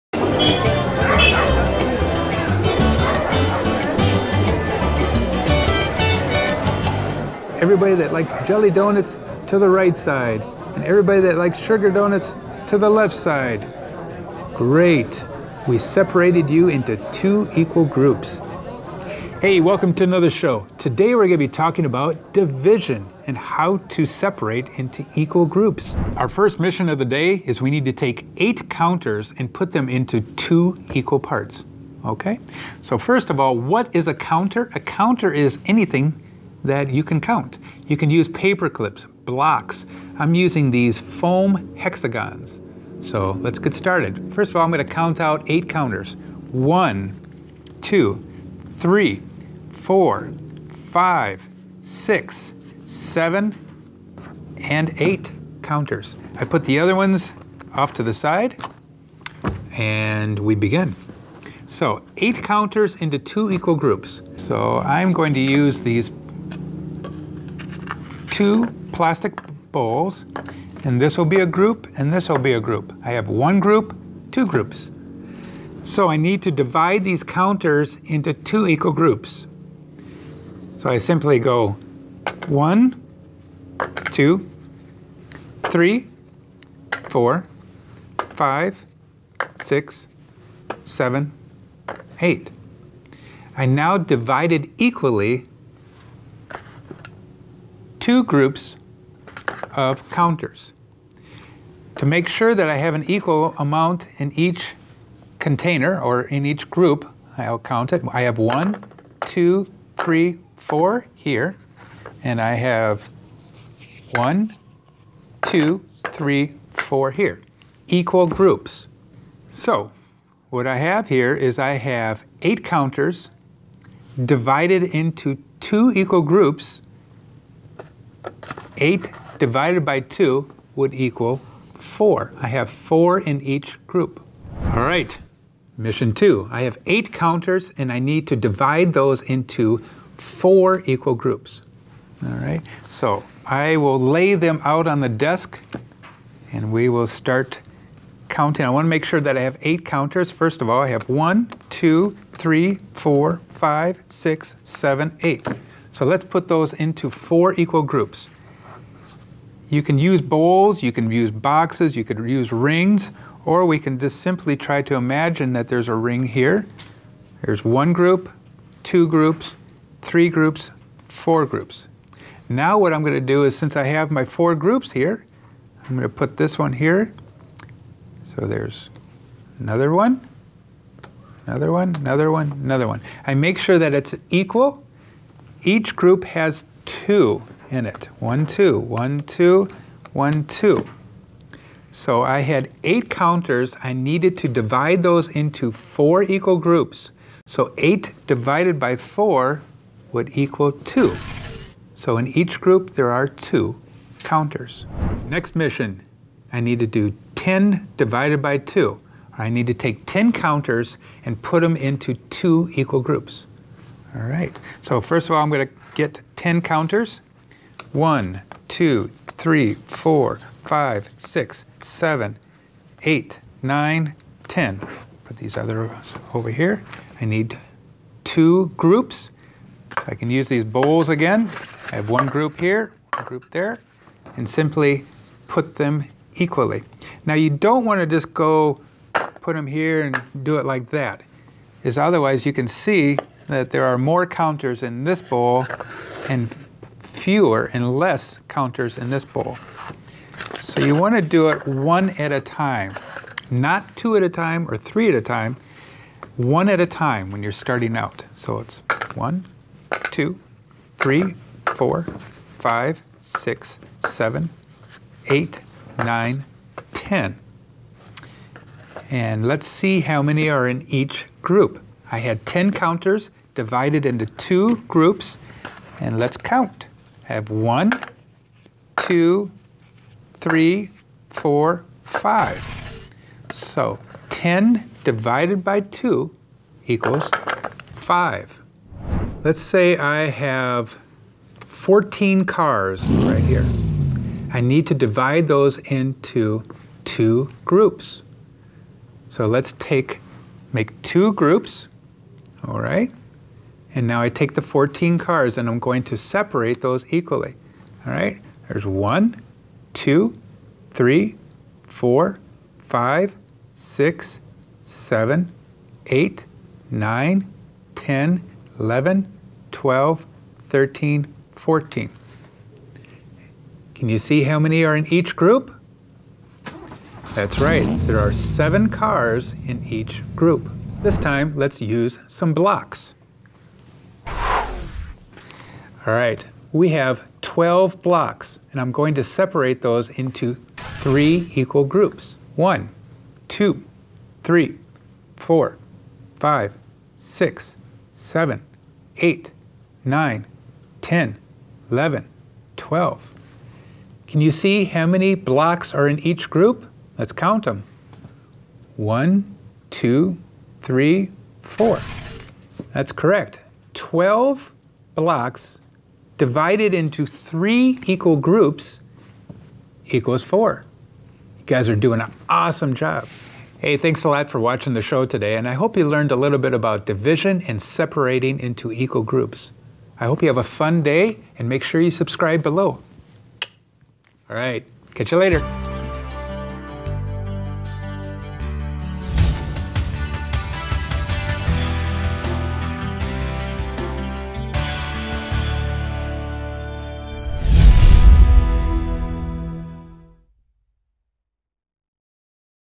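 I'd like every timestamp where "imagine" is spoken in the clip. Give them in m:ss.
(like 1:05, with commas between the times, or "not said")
2:44.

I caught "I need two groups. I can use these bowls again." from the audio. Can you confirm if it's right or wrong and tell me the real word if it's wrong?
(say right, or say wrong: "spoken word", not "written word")
right.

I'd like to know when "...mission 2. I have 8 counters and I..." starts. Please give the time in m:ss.
2:15.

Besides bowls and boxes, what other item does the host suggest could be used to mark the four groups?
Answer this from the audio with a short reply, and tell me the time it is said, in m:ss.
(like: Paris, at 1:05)
Rings, at 2:42.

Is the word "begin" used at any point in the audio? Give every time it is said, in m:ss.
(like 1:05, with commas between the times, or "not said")
1:00.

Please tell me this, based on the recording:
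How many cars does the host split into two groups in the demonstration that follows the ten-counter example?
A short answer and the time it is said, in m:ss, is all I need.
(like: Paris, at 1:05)
14, at 4:51.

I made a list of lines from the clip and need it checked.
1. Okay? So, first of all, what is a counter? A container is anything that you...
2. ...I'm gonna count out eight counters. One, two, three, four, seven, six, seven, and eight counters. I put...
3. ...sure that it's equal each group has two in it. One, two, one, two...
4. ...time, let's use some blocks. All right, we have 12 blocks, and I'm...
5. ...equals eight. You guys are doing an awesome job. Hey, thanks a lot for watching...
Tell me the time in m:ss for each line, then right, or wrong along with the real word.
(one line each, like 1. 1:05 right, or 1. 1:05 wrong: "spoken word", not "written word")
1. 0:32 wrong: "counter", not "container"
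2. 0:44 wrong: "five", not "seven"
3. 3:03 right
4. 5:31 right
5. 6:10 wrong: "four", not "eight".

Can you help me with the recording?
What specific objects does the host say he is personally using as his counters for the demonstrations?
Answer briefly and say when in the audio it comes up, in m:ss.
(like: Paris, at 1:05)
Foam hexagons, at 0:40.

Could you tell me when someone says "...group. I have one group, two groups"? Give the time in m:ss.
1:12.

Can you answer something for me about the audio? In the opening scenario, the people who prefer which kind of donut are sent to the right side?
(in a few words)
Jelly donuts.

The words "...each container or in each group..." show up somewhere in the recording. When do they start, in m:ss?
1:44.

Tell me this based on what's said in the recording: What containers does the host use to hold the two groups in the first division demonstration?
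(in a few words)
Plastic bowls.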